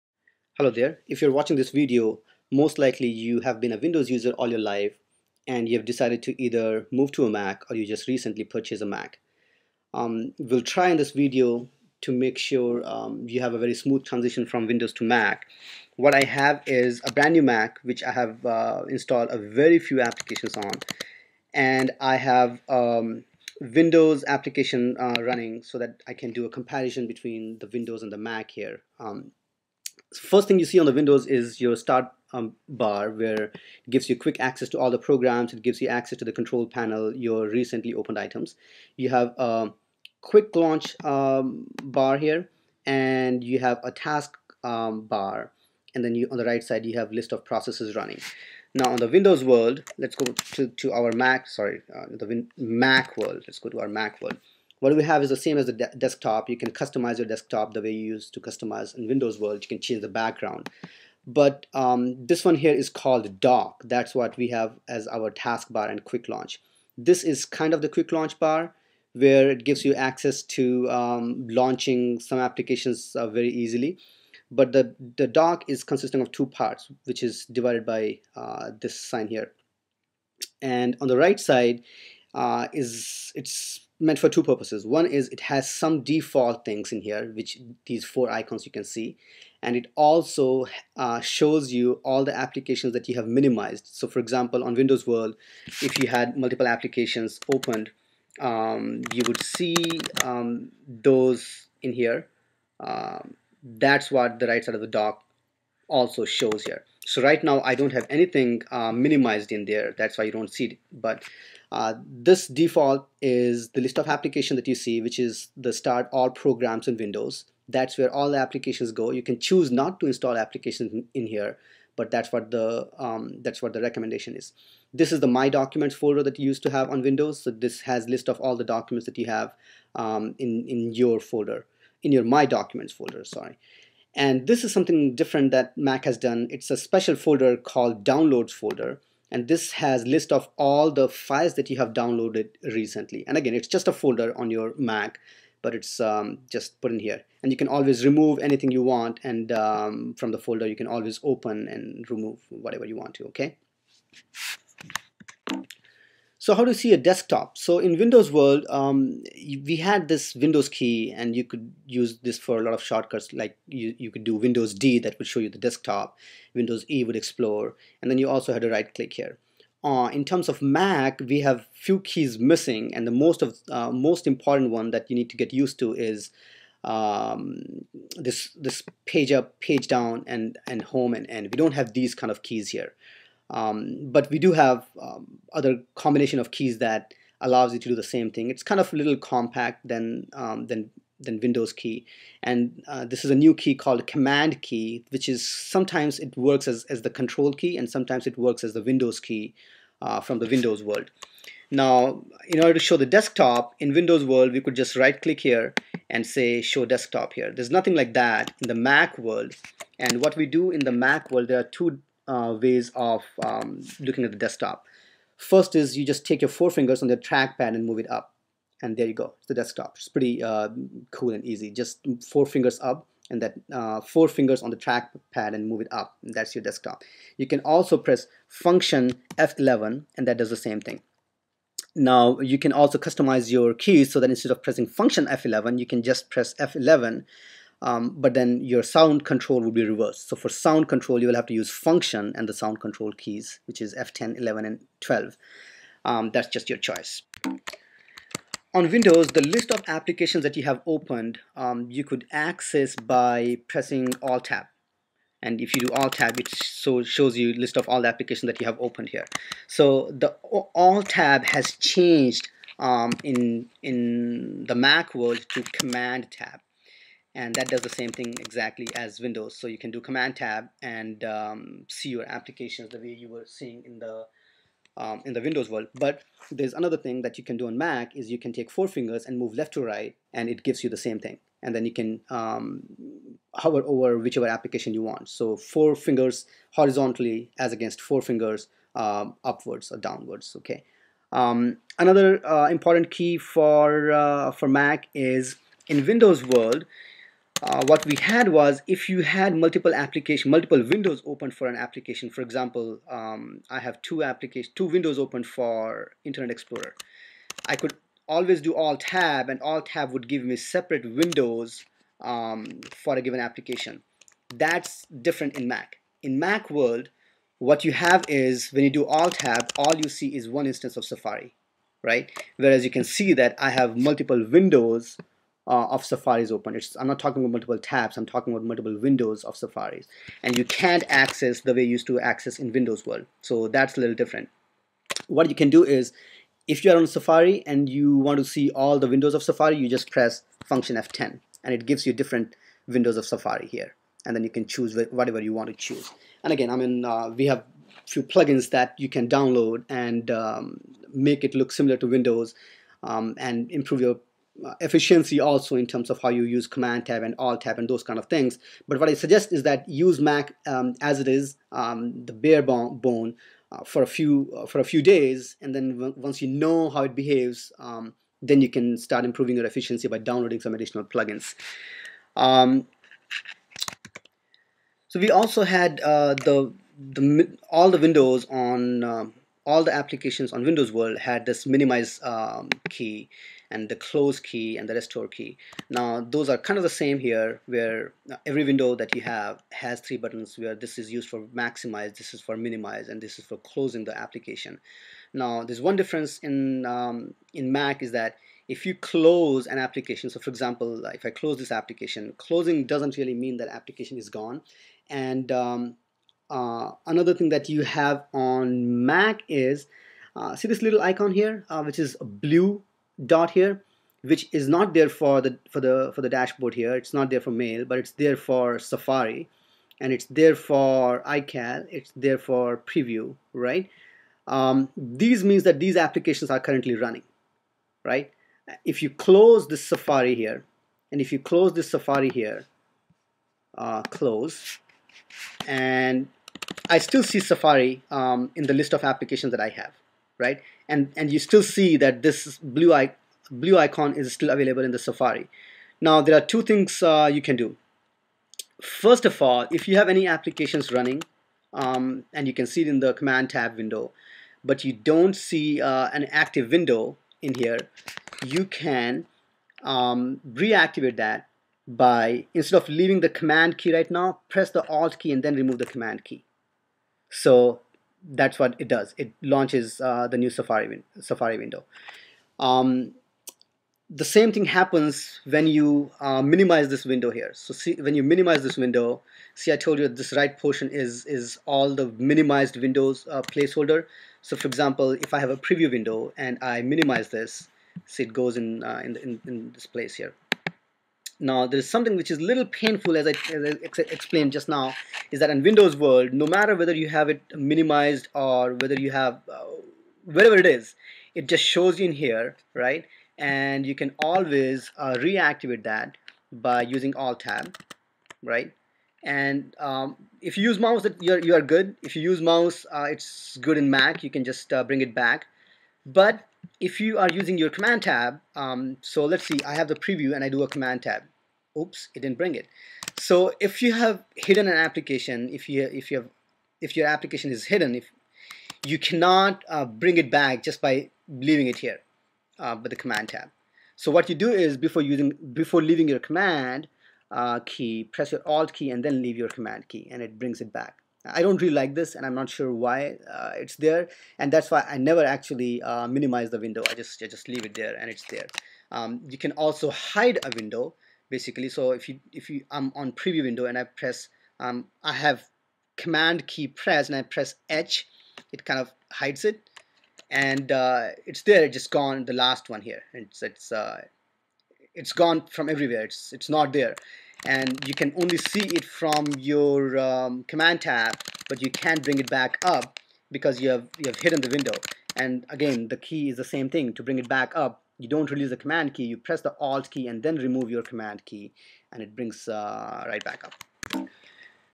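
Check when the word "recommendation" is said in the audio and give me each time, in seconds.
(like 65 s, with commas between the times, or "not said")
123 s.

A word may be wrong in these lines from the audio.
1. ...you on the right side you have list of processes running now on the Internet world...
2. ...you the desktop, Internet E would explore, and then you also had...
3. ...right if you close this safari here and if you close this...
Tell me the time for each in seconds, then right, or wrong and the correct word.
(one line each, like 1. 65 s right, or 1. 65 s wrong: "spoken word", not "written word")
1. 46 s wrong: "Windows", not "Internet"
2. 165 s wrong: "Windows", not "Internet"
3. 428 s right.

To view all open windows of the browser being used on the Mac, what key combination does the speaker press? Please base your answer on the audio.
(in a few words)
function F10.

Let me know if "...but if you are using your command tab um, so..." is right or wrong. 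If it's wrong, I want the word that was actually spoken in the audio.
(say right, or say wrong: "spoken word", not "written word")
right.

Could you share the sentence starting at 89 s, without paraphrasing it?
And it also uh, shows you all the applications that you have minimized.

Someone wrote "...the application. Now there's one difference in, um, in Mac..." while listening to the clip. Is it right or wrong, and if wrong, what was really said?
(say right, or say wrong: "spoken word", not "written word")
right.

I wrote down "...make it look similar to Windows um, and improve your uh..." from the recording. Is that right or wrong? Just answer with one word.
right.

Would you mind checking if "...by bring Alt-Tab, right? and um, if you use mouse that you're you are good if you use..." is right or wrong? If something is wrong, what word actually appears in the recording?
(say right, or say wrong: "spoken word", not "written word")
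wrong: "using", not "bring".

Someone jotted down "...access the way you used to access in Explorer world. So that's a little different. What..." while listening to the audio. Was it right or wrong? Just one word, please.
wrong.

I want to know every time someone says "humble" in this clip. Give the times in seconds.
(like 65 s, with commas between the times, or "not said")
not said.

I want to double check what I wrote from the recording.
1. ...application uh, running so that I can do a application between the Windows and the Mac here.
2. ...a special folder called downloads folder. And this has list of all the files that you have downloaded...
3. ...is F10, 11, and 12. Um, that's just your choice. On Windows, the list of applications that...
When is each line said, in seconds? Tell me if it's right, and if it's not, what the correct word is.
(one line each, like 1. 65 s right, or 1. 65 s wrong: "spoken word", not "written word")
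1. 24 s wrong: "comparison", not "application"
2. 136 s right
3. 243 s right.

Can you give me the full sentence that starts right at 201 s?
Now, in order to show the desktop in Windows world, we could just right click here and say show desktop here.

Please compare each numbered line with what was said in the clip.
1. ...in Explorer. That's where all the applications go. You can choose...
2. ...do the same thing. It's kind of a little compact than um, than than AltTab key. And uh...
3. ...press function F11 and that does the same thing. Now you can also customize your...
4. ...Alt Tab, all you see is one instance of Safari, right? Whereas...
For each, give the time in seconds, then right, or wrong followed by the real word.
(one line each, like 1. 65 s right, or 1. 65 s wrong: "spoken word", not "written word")
1. 116 s wrong: "Windows", not "Explorer"
2. 187 s wrong: "Windows", not "AltTab"
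3. 227 s right
4. 319 s right.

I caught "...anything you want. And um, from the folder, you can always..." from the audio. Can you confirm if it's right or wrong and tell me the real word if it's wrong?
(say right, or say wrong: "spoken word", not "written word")
right.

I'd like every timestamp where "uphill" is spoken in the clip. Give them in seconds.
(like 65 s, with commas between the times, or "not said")
not said.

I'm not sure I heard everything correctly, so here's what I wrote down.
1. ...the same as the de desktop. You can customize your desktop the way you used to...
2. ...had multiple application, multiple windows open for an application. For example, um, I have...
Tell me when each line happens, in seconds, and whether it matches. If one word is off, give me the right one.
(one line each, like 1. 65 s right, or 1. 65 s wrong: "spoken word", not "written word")
1. 55 s right
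2. 299 s right.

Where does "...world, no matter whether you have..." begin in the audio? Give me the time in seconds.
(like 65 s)
495 s.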